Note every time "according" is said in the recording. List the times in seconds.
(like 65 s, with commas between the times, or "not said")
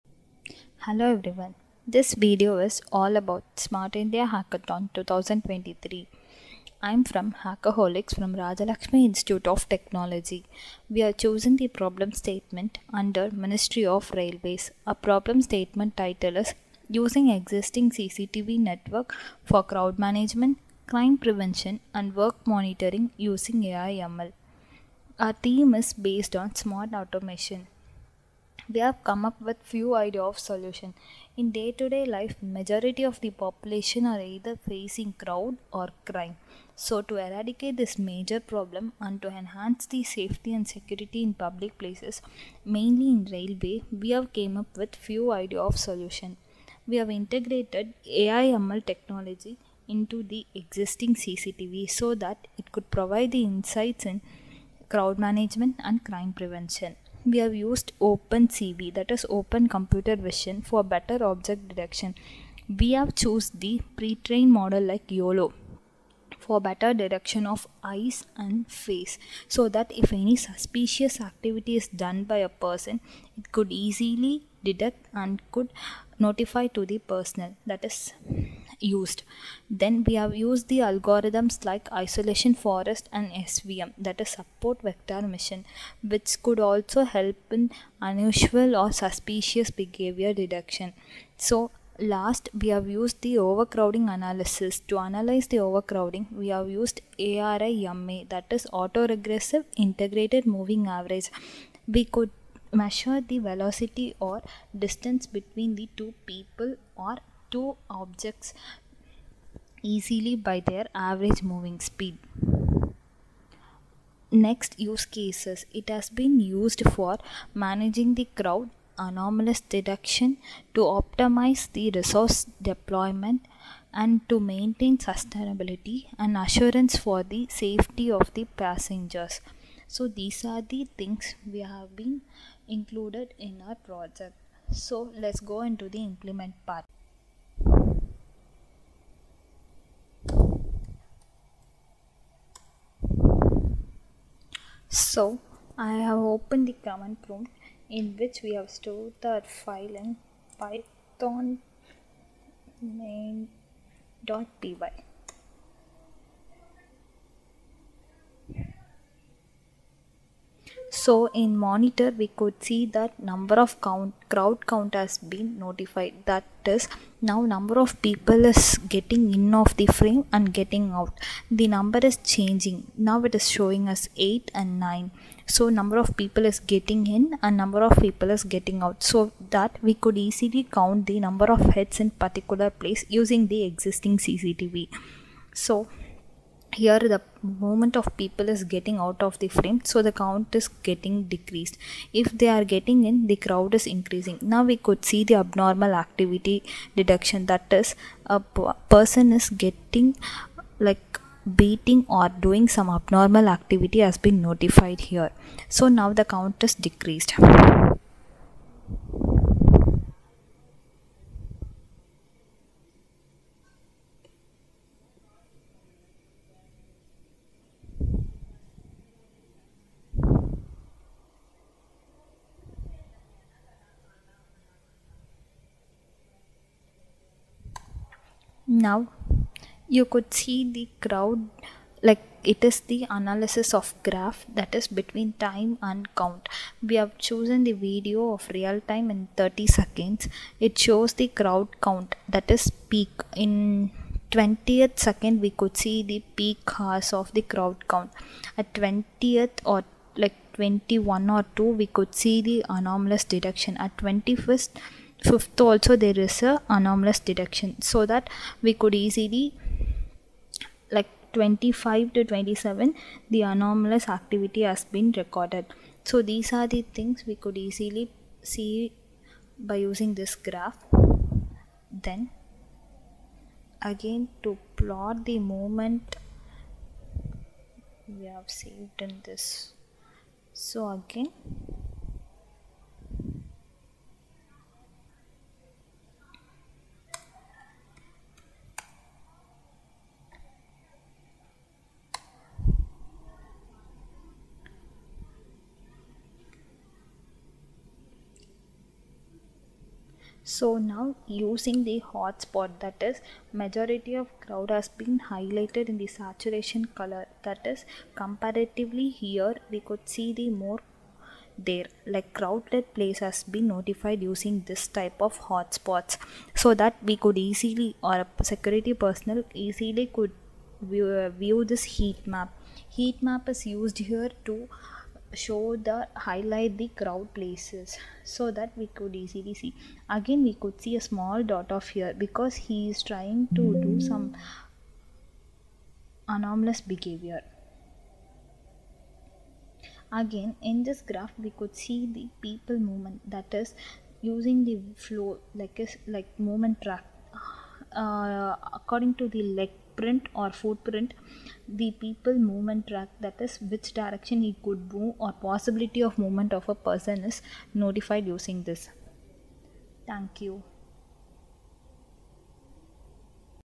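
348 s.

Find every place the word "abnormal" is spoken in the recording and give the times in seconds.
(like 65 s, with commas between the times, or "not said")
195 s, 202 s.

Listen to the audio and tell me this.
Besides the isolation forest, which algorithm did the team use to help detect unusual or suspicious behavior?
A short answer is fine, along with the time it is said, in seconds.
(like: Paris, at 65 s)
Support vector machine, at 84 s.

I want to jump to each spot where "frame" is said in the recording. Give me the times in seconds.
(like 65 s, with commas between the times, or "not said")
169 s, 189 s.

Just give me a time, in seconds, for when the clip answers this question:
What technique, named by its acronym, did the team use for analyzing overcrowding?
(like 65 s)
97 s.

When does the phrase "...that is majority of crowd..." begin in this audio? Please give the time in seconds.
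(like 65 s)
302 s.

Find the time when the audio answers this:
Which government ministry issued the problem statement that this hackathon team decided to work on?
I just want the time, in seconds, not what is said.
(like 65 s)
13 s.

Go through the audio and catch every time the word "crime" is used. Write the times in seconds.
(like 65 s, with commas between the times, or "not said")
20 s, 36 s, 56 s.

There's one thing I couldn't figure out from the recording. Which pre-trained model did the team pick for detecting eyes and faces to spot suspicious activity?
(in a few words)
YOLO.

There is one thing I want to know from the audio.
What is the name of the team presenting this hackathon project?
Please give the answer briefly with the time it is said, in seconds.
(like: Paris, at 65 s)
Hackaholics, at 7 s.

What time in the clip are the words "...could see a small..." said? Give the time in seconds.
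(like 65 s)
330 s.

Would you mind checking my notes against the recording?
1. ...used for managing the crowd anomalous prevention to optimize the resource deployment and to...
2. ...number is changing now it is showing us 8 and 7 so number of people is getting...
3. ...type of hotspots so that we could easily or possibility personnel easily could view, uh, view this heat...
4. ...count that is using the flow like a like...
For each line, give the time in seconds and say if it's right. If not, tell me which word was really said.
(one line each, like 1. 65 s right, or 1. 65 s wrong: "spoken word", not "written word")
1. 116 s wrong: "detection", not "prevention"
2. 171 s wrong: "9", not "7"
3. 314 s wrong: "security", not "possibility"
4. 342 s wrong: "movement", not "count".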